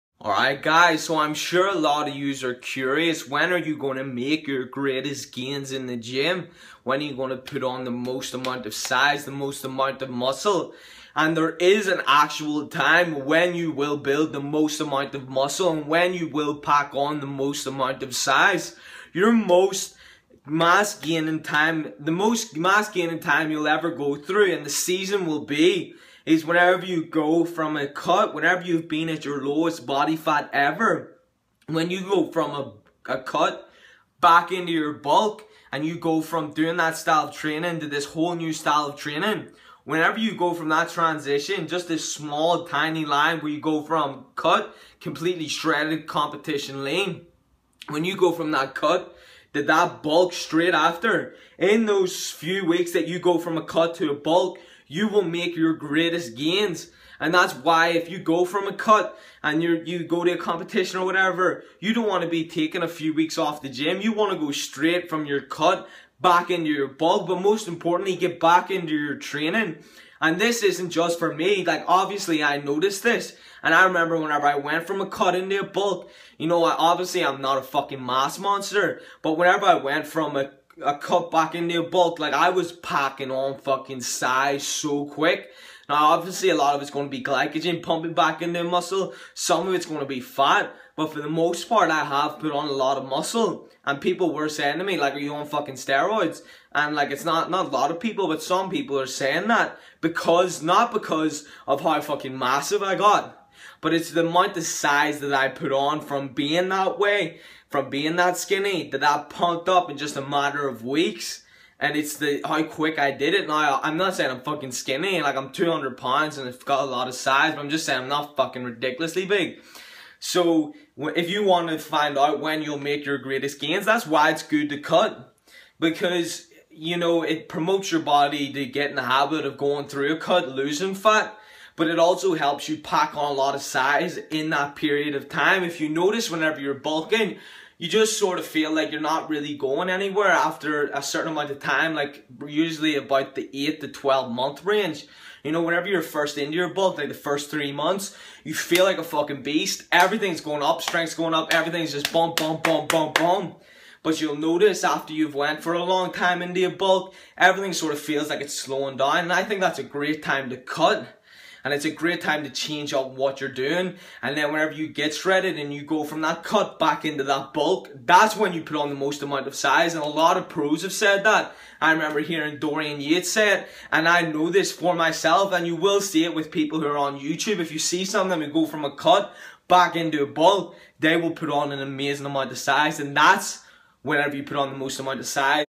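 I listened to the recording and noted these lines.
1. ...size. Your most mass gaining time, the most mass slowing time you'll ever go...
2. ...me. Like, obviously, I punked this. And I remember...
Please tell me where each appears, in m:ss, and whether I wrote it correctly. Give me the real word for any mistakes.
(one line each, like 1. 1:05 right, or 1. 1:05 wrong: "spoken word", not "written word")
1. 0:18 wrong: "gaining", not "slowing"
2. 1:11 wrong: "noticed", not "punked".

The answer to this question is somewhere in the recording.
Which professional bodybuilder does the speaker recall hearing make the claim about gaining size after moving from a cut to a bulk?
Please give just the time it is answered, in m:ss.
2:52.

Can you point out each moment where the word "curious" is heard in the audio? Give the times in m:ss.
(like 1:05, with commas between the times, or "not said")
0:02.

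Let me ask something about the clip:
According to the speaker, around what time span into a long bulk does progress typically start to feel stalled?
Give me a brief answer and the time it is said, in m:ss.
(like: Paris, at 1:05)
8 to 12 months, at 2:23.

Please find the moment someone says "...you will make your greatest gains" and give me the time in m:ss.
0:54.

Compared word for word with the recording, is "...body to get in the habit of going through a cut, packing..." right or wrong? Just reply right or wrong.
wrong.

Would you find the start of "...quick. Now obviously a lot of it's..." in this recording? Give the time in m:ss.
1:25.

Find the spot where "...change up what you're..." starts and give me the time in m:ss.
2:42.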